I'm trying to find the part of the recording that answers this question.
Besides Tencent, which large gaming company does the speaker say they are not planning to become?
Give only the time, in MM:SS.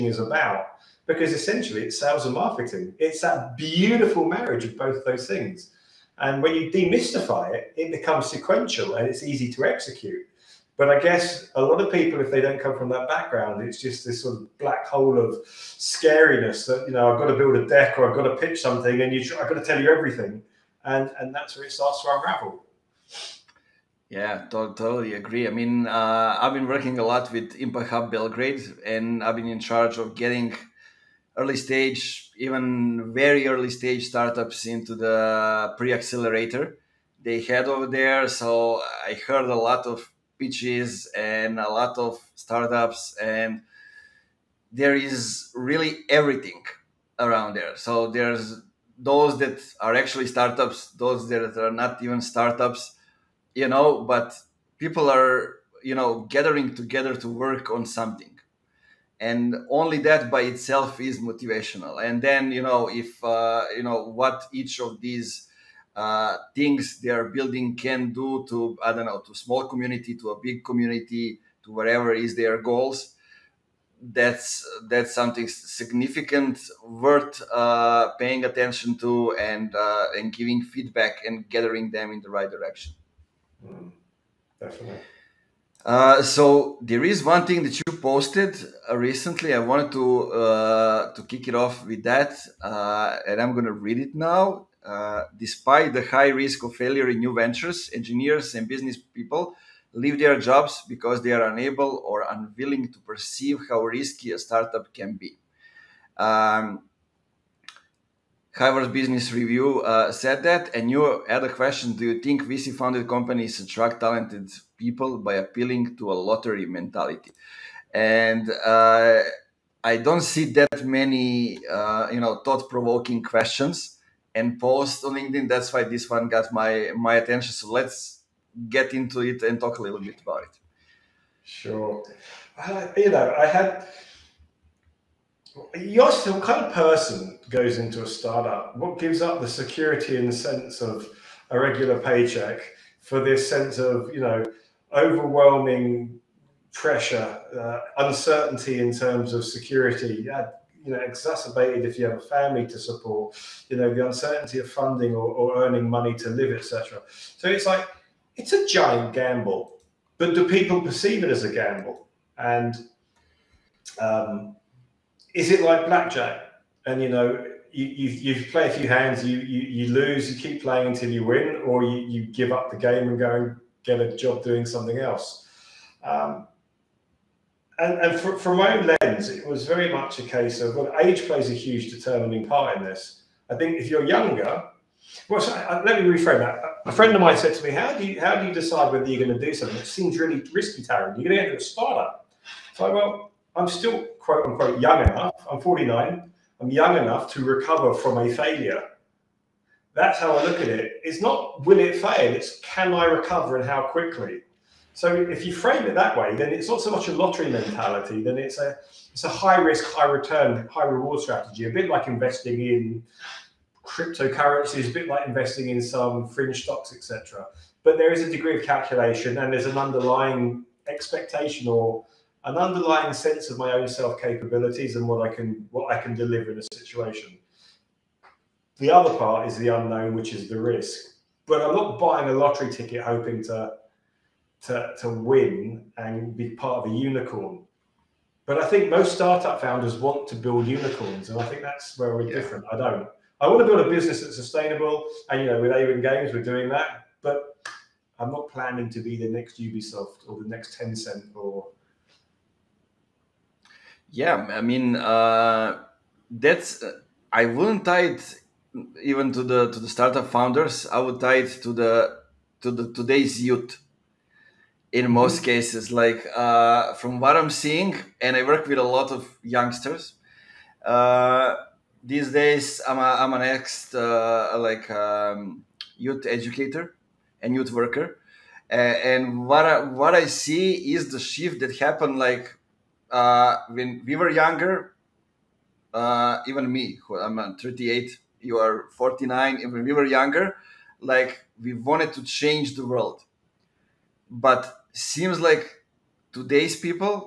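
04:09.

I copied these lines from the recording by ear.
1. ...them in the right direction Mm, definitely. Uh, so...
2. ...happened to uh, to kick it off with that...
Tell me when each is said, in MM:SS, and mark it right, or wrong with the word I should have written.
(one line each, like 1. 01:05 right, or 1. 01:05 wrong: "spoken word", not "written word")
1. 01:21 right
2. 01:29 wrong: "wanted", not "happened".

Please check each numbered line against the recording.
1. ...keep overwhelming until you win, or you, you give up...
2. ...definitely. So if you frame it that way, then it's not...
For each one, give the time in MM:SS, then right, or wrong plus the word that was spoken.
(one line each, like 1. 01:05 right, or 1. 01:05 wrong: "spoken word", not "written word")
1. 02:50 wrong: "playing", not "overwhelming"
2. 03:23 wrong: "quickly", not "definitely".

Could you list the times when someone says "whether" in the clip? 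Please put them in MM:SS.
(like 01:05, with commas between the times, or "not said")
03:08.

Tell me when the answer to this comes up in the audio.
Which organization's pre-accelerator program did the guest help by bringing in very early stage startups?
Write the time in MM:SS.
00:27.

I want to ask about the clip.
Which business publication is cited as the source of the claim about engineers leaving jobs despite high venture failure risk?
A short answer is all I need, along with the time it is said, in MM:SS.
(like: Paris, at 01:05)
Harvard Business Review, at 01:48.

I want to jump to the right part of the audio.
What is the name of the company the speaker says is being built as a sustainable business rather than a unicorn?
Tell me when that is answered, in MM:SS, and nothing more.
04:05.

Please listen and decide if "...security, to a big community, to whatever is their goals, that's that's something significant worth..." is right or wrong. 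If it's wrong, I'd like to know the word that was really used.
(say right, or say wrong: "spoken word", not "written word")
wrong: "community", not "security".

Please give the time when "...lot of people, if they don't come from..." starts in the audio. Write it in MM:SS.
00:11.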